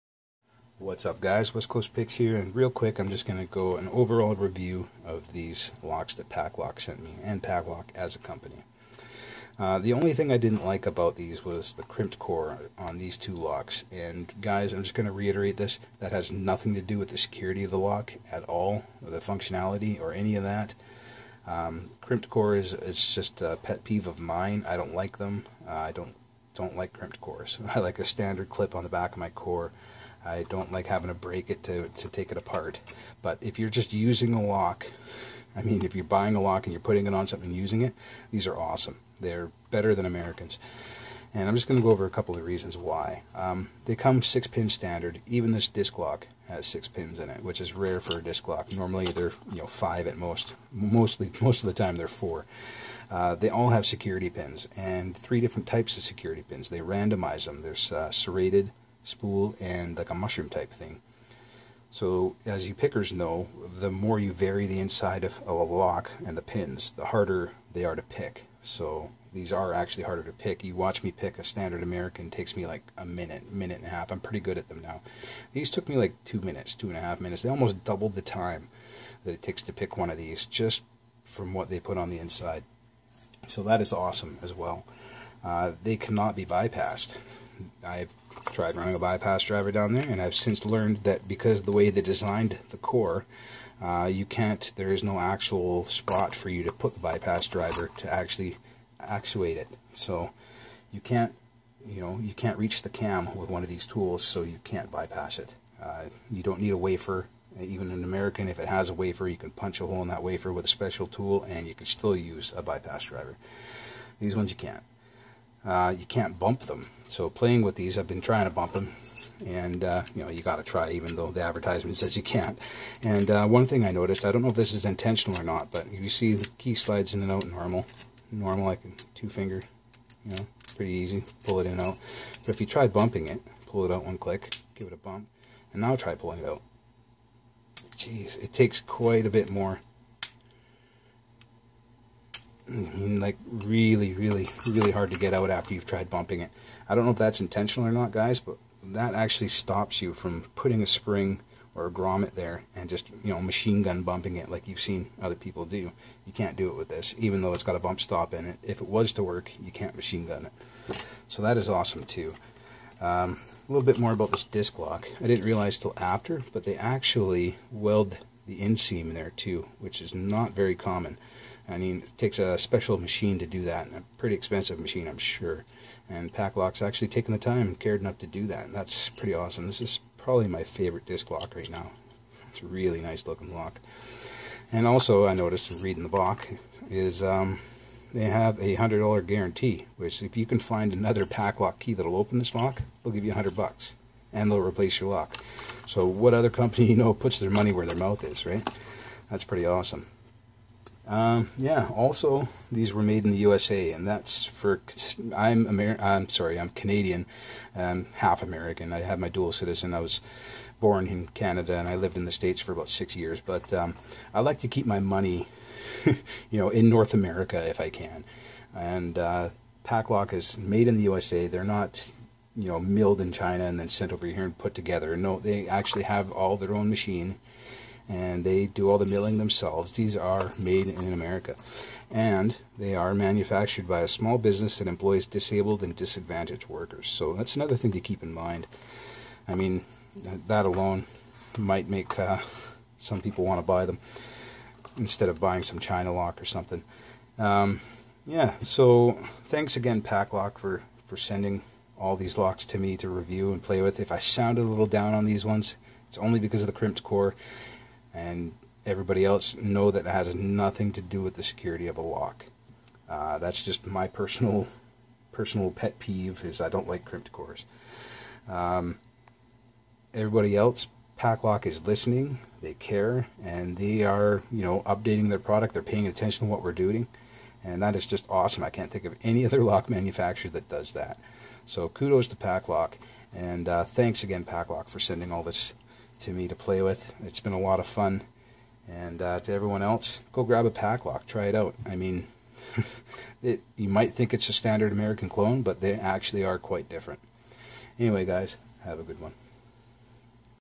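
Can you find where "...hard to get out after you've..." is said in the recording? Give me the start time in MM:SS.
02:24.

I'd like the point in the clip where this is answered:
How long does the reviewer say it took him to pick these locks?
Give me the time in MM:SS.
01:16.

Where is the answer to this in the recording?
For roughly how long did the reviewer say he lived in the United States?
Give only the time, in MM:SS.
03:32.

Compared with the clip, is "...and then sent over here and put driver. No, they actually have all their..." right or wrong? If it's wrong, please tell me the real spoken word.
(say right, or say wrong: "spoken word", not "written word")
wrong: "together", not "driver".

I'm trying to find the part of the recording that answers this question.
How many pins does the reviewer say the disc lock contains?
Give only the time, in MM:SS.
00:46.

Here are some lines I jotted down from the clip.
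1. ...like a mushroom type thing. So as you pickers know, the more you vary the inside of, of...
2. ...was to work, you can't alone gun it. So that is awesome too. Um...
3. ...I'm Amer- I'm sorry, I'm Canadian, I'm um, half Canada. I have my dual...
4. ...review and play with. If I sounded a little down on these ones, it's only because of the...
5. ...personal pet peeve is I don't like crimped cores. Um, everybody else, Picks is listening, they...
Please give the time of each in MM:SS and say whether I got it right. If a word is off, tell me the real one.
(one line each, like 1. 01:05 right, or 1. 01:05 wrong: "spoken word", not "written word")
1. 00:59 right
2. 02:38 wrong: "machine", not "alone"
3. 03:25 wrong: "American", not "Canada"
4. 04:13 right
5. 04:25 wrong: "Paclock", not "Picks".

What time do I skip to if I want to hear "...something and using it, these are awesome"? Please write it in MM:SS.
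00:37.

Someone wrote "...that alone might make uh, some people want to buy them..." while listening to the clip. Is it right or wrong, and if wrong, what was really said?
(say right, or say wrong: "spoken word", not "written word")
right.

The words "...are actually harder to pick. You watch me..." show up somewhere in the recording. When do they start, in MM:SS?
01:09.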